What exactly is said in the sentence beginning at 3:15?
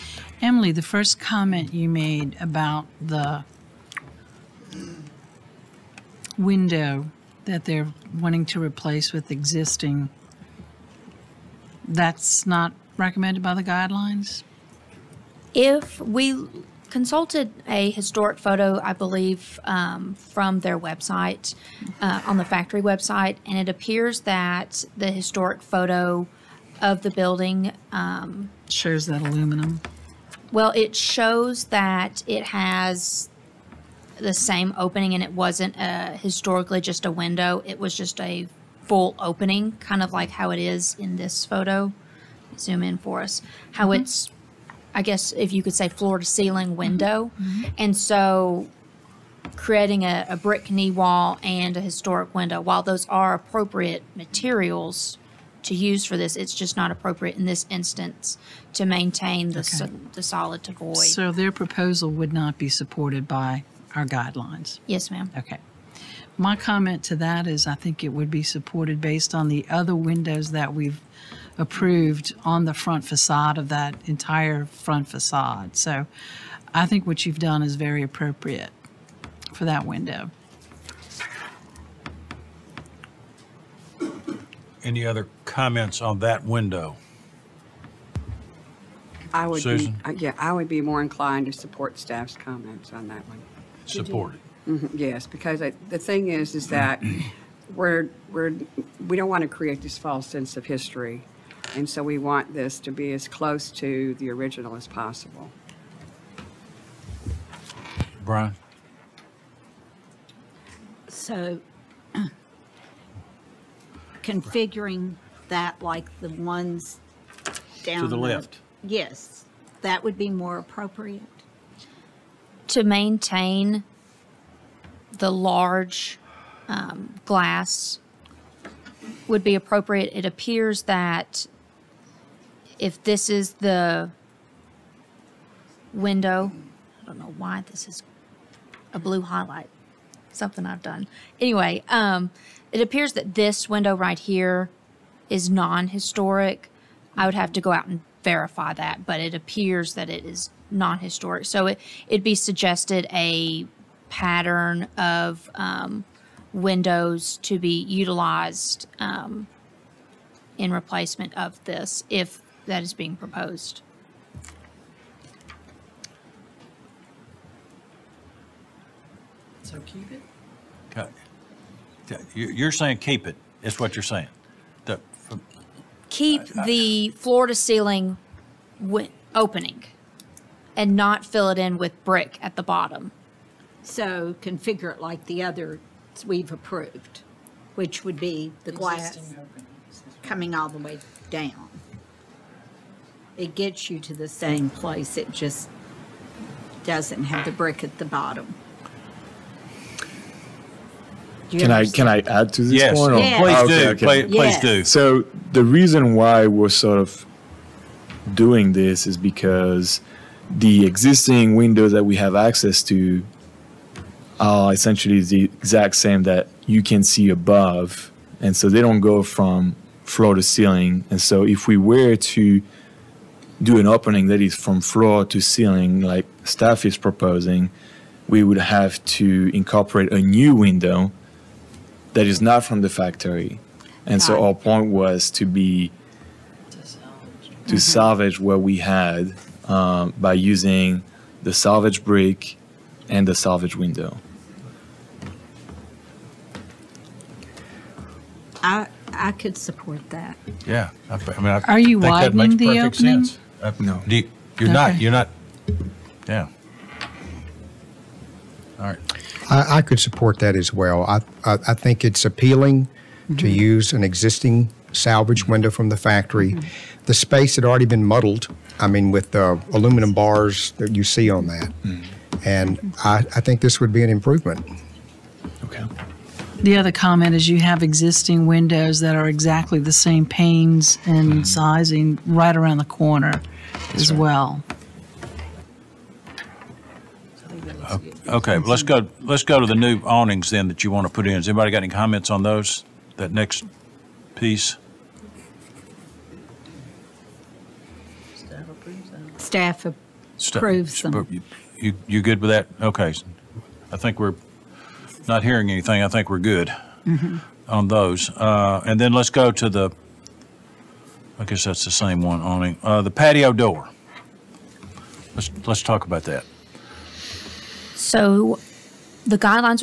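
It just doesn't have the brick at the bottom.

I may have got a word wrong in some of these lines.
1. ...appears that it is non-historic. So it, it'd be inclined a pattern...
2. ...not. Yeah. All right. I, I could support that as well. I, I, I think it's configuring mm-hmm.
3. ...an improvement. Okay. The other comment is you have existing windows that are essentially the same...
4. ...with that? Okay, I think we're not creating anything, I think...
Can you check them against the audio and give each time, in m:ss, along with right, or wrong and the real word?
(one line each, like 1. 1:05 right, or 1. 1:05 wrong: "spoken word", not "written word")
1. 2:29 wrong: "suggested", not "inclined"
2. 4:15 wrong: "appealing", not "configuring"
3. 4:34 wrong: "exactly", not "essentially"
4. 5:02 wrong: "hearing", not "creating".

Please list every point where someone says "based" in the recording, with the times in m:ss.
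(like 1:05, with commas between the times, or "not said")
1:09.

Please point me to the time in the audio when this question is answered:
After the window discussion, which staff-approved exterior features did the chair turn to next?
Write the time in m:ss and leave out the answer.
4:50.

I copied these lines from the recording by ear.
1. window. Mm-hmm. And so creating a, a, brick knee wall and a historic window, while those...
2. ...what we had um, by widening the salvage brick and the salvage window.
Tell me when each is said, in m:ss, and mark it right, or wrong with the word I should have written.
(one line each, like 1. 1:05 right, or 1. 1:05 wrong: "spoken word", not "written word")
1. 0:46 right
2. 3:58 wrong: "using", not "widening".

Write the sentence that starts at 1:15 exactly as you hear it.
So I think what you've done is very appropriate for that window.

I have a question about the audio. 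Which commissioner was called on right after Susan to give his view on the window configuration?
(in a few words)
Brian.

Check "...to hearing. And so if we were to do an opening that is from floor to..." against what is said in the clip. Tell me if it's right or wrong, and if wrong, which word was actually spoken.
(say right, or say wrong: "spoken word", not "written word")
wrong: "ceiling", not "hearing".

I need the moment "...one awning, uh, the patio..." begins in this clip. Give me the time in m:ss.
5:12.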